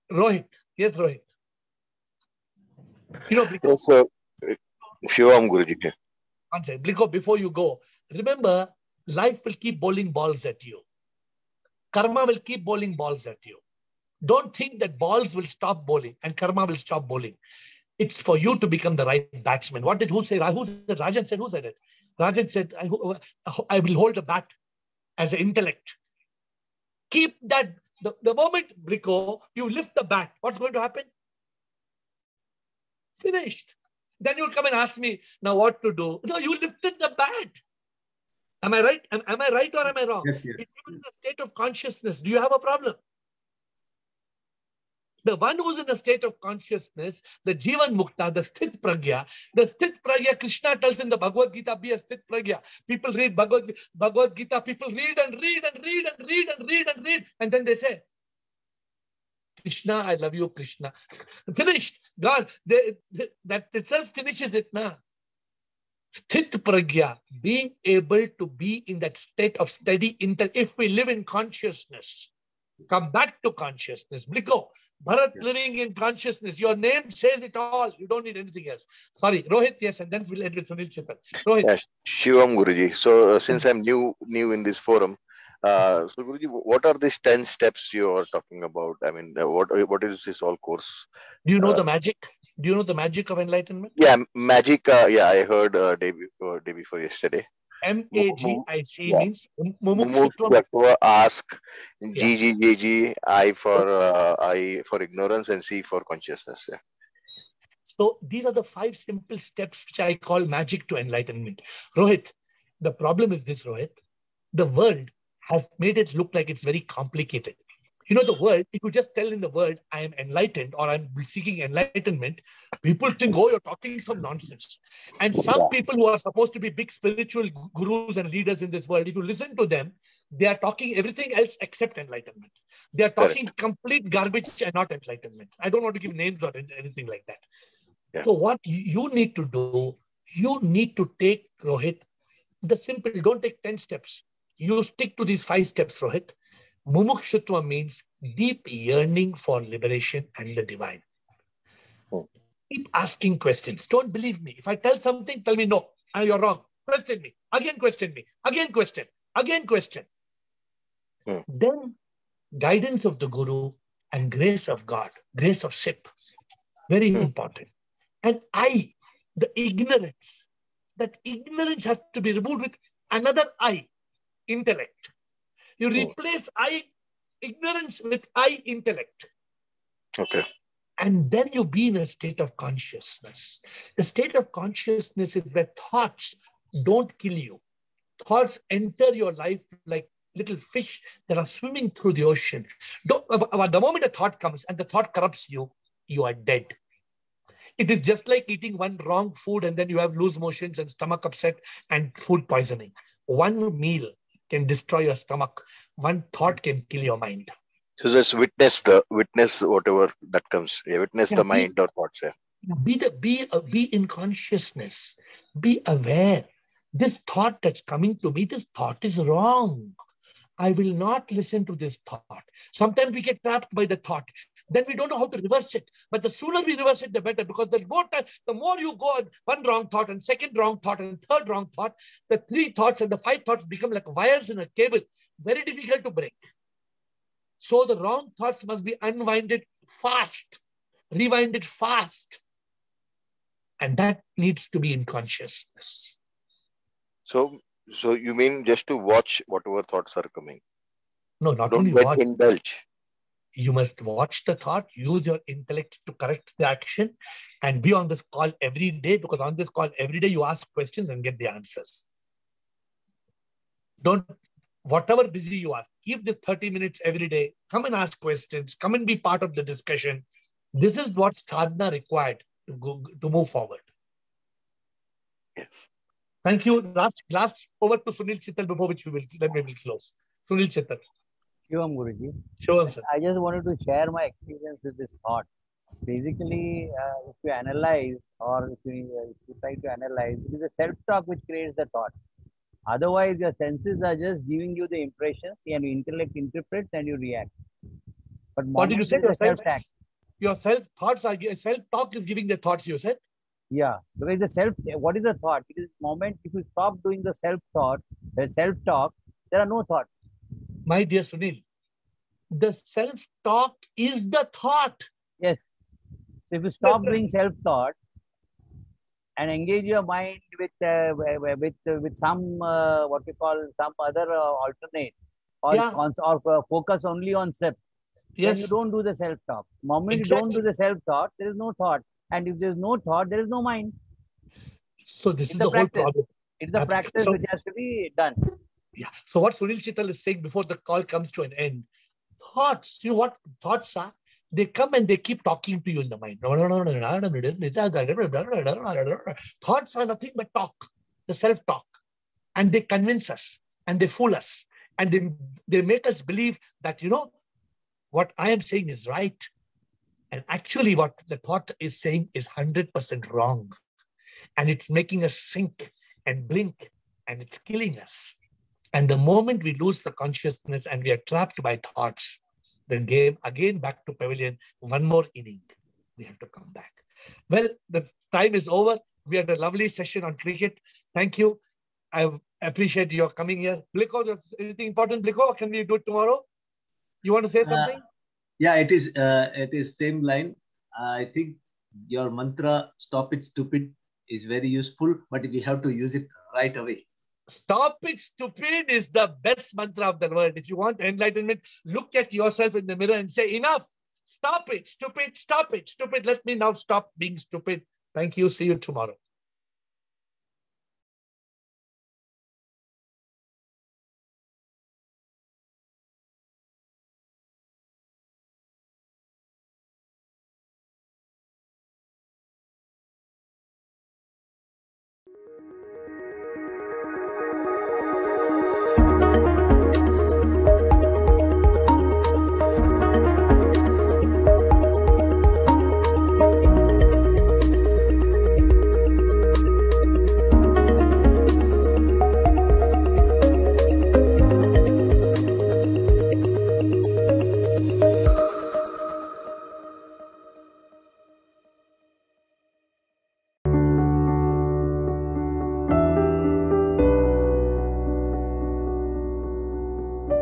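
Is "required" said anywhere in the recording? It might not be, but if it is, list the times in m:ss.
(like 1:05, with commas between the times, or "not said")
4:31.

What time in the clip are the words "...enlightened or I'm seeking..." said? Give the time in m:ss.
2:00.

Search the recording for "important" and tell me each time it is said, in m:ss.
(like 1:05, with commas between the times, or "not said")
2:47, 6:24.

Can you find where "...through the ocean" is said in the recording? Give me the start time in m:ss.
3:11.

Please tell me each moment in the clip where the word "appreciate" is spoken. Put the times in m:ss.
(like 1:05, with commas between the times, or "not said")
6:22.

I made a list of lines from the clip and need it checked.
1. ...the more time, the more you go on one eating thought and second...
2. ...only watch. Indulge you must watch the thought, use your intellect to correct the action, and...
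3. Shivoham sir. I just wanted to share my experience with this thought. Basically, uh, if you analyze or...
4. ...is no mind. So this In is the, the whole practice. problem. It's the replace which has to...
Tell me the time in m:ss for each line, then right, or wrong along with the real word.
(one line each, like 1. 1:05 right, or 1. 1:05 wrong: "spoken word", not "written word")
1. 3:47 wrong: "wrong", not "eating"
2. 4:11 right
3. 4:42 right
4. 5:33 wrong: "practice", not "replace".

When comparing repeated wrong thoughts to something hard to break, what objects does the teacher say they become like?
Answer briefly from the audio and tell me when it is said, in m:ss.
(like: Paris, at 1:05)
Wires in a cable, at 3:54.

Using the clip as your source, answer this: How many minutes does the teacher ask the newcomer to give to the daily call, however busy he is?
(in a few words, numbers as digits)
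30.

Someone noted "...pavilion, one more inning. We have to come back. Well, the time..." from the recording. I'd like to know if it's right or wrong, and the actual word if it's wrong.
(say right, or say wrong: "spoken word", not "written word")
right.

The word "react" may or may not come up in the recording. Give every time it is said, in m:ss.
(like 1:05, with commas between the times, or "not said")
4:57.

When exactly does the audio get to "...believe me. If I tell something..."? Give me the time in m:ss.
2:34.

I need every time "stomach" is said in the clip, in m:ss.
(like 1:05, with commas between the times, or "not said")
3:20, 3:25.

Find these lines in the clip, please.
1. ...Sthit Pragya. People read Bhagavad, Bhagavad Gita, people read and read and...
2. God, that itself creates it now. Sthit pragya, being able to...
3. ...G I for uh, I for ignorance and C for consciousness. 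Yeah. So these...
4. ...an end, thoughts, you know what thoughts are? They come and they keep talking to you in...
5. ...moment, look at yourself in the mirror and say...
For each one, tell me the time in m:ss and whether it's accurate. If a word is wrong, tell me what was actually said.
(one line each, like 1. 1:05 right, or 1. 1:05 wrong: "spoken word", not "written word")
1. 0:51 right
2. 1:02 wrong: "finishes", not "creates"
3. 1:43 right
4. 5:41 right
5. 6:41 wrong: "enlightenment", not "moment".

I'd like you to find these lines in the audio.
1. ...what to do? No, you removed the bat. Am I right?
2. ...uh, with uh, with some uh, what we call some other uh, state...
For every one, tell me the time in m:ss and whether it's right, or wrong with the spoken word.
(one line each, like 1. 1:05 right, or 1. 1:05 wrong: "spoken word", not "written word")
1. 0:35 wrong: "lifted", not "removed"
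2. 5:20 wrong: "alternate", not "state".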